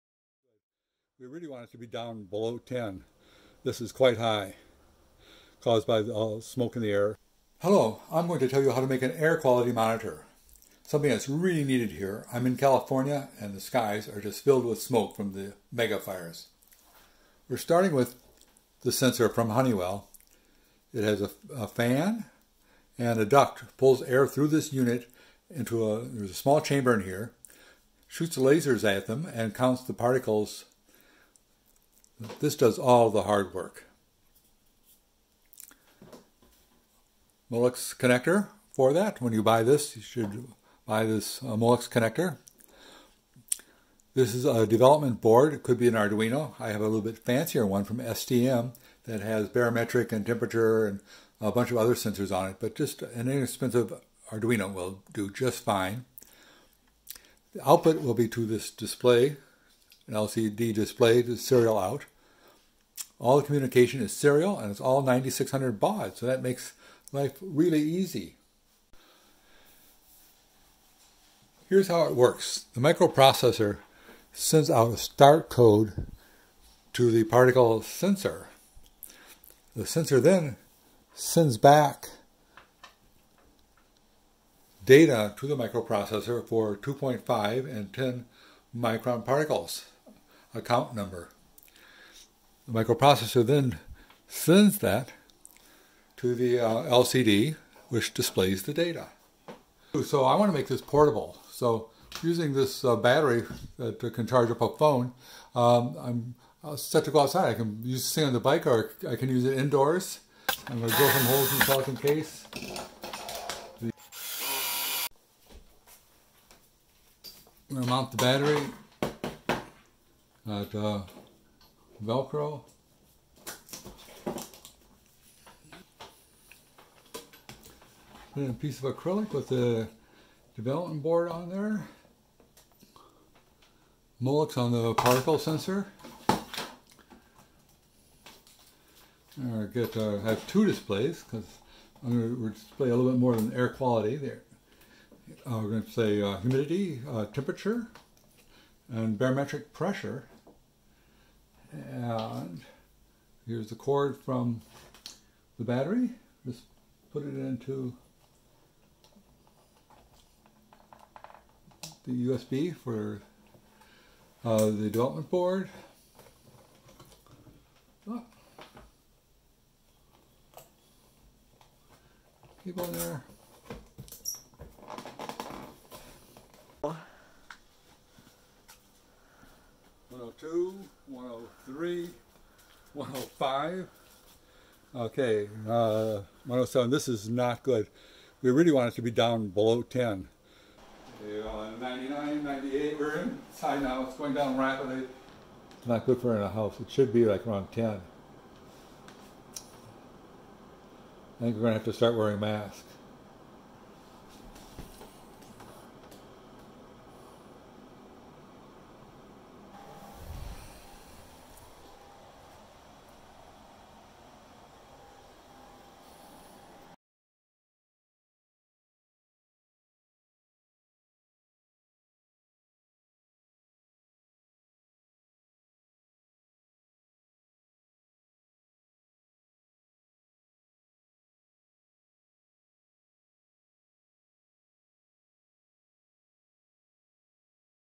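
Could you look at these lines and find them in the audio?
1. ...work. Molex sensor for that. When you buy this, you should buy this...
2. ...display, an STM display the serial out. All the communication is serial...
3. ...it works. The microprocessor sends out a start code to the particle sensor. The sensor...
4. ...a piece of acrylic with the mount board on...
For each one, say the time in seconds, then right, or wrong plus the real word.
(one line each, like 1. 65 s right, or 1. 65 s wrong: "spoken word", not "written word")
1. 33 s wrong: "connector", not "sensor"
2. 58 s wrong: "LCD", not "STM"
3. 72 s right
4. 128 s wrong: "development", not "mount".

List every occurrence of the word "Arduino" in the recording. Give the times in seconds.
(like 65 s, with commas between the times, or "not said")
45 s, 54 s.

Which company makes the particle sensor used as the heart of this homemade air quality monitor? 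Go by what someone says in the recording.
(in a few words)
Honeywell.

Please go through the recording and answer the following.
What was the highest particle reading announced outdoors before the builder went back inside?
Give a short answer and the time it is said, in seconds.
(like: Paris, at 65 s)
107, at 186 s.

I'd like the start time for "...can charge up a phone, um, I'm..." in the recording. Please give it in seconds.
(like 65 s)
104 s.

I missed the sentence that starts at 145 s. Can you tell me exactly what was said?
Uh, we're going to say uh, humidity, uh, temperature, and barometric pressure.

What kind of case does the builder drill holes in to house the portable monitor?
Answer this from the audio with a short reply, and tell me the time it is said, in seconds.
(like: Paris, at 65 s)
Falcon case, at 111 s.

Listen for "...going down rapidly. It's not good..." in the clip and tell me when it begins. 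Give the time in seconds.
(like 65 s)
194 s.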